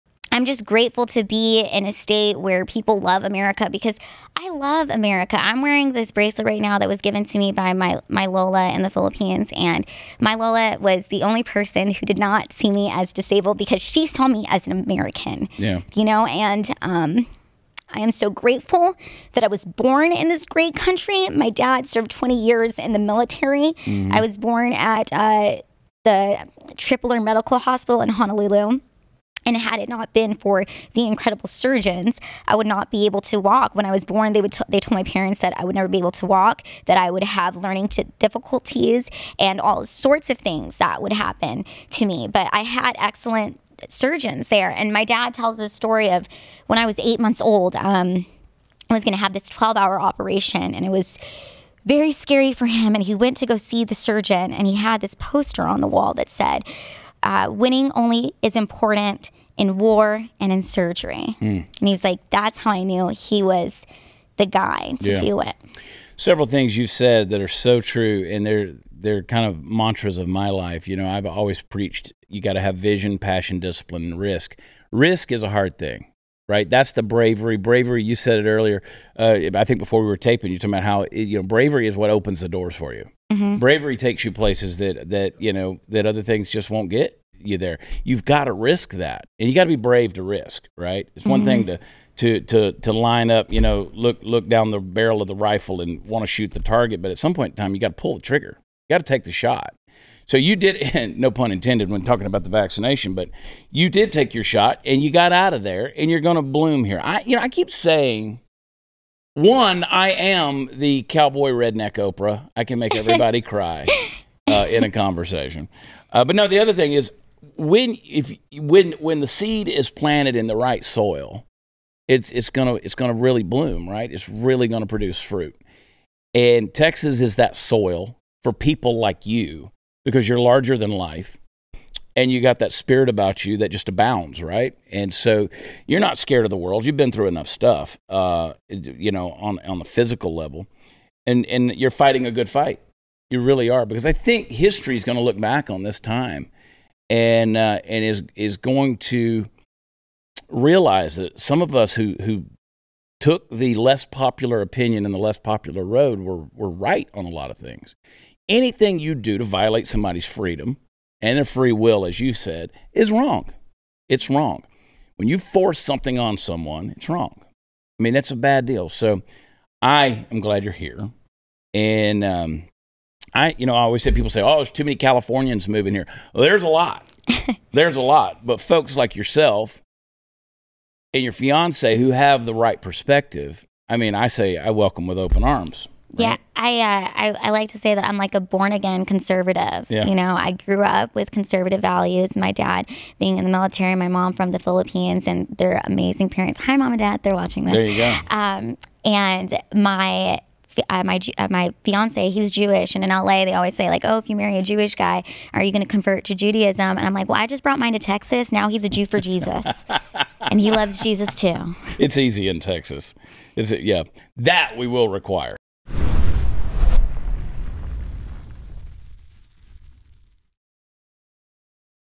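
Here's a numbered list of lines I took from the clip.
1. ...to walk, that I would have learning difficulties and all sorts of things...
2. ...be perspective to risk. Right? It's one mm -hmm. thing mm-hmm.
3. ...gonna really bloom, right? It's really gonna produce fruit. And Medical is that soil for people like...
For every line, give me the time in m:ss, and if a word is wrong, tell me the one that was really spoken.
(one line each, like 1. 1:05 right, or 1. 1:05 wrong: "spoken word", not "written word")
1. 0:36 right
2. 1:29 wrong: "brave", not "perspective"
3. 2:02 wrong: "Texas", not "Medical".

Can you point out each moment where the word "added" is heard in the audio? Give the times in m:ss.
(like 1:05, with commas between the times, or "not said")
not said.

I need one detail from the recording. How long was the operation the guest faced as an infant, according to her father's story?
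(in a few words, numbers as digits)
12 hours.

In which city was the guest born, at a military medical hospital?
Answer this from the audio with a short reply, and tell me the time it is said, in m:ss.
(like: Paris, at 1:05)
Honolulu, at 0:28.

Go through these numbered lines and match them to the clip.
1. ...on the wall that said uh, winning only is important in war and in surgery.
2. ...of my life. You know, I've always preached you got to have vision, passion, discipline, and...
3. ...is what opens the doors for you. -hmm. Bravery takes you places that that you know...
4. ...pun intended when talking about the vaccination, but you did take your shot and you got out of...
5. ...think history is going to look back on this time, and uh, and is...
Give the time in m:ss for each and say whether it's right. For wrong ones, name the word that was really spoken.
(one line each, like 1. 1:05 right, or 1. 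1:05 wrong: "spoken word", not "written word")
1. 0:55 right
2. 1:10 right
3. 1:21 right
4. 1:41 right
5. 2:24 right.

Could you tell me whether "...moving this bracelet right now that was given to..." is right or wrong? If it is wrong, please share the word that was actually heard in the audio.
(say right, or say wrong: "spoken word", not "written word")
wrong: "wearing", not "moving".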